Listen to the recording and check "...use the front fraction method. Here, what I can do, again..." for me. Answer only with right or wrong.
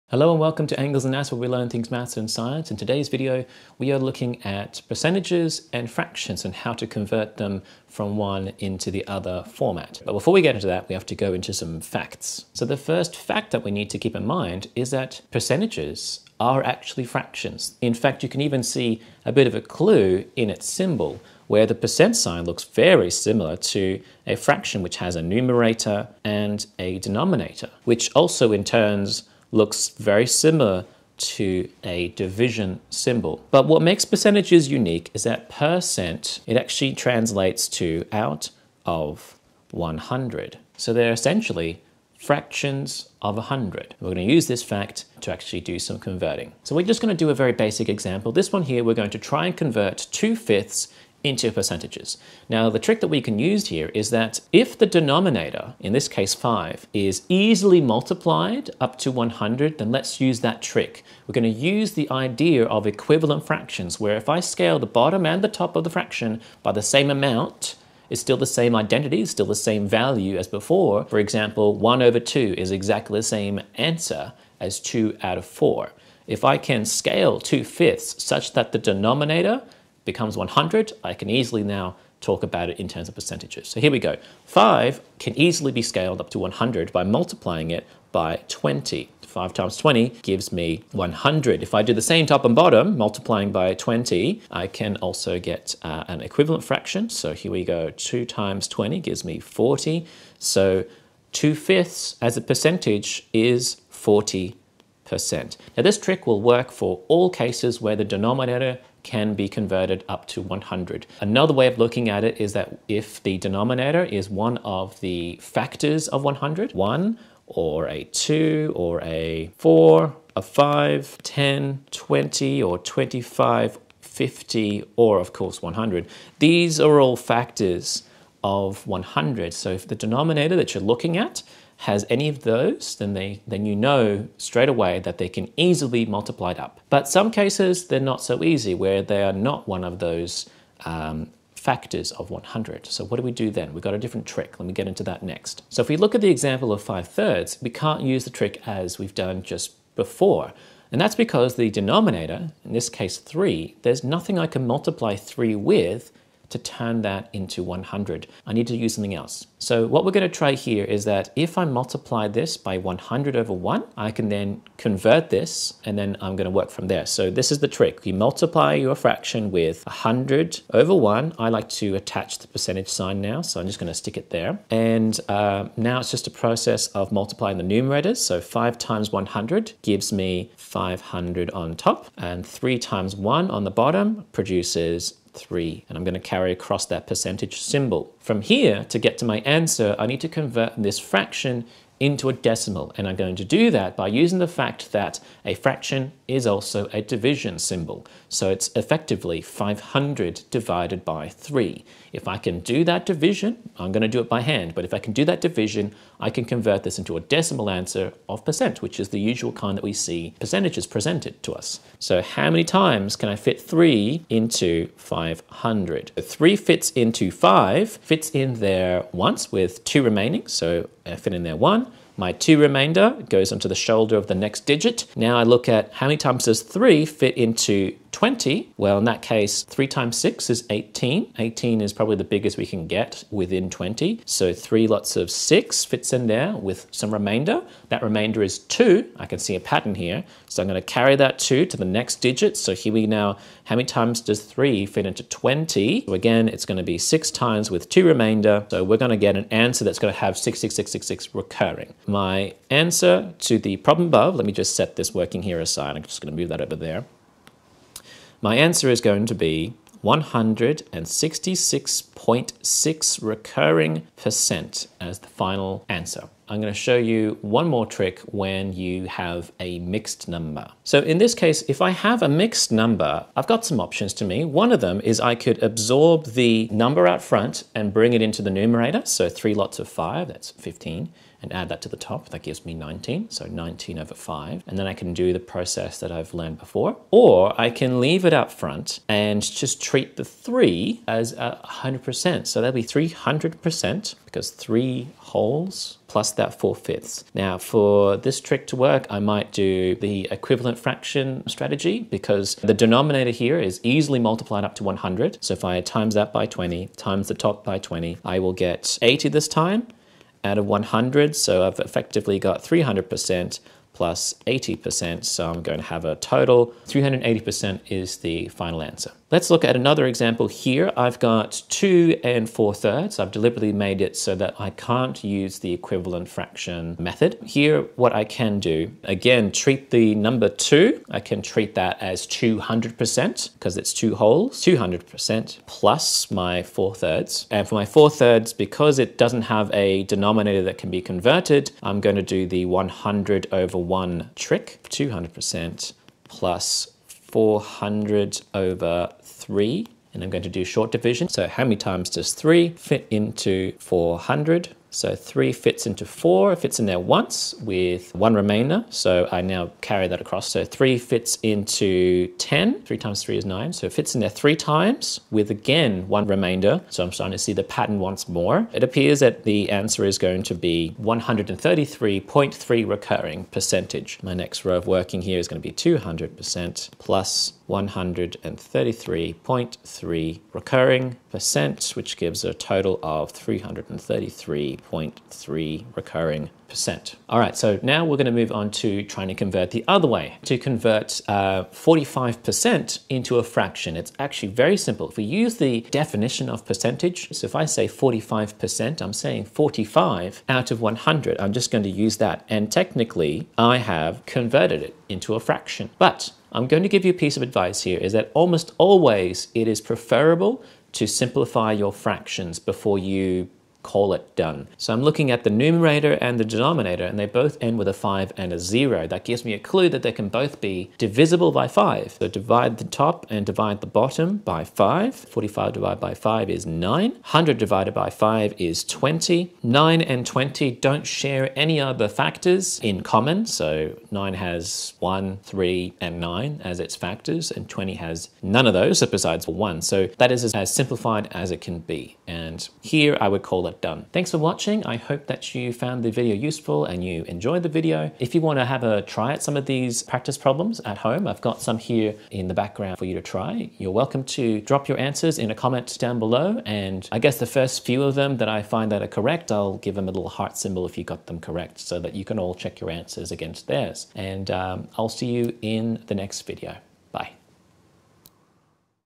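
wrong.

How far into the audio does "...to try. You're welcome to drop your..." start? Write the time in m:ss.
7:33.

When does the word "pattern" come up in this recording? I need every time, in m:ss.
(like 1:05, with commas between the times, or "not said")
3:59, 6:07.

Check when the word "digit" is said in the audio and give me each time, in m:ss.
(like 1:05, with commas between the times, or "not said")
3:44, 4:02.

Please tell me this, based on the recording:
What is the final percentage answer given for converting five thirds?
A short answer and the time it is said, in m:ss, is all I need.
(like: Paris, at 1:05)
166.6 recurring %, at 4:20.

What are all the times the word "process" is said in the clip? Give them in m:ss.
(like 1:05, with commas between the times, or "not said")
2:56, 4:45.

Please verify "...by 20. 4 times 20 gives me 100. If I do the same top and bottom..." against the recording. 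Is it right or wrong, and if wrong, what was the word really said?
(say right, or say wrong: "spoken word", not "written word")
wrong: "5", not "4".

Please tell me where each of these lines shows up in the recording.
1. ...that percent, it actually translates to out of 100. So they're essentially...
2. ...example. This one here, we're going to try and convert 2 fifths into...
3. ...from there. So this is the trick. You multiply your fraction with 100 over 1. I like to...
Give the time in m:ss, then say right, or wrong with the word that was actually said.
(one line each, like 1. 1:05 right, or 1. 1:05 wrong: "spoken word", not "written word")
1. 0:35 right
2. 0:47 right
3. 2:46 right.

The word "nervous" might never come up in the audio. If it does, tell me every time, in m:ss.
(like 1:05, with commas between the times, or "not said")
not said.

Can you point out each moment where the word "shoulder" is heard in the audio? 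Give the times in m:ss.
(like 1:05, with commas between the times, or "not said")
3:43.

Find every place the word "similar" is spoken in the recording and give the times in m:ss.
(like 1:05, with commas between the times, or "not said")
0:23, 0:30.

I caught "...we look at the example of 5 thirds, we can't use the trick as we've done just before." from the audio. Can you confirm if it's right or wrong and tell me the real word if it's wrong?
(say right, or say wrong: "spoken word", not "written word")
right.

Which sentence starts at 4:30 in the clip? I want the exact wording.
So in this case, if I have a mixed number, I've got some options to me.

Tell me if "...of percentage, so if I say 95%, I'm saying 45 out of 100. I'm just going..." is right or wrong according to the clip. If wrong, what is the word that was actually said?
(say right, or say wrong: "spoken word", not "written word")
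wrong: "45", not "95".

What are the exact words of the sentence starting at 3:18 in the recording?
So it's effectively 500 divided by 3.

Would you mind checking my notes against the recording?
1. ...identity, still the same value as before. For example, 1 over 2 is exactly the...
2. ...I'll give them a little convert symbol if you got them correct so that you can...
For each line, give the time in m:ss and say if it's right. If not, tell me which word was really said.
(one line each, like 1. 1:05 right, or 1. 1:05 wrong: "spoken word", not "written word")
1. 1:08 right
2. 7:39 wrong: "heart", not "convert".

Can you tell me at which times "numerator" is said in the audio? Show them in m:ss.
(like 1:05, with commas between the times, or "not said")
0:25, 2:57, 4:38, 6:55.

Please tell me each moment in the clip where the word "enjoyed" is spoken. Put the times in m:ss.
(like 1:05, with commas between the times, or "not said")
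7:27.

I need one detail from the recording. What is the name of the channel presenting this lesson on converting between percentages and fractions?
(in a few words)
Angles and Maths.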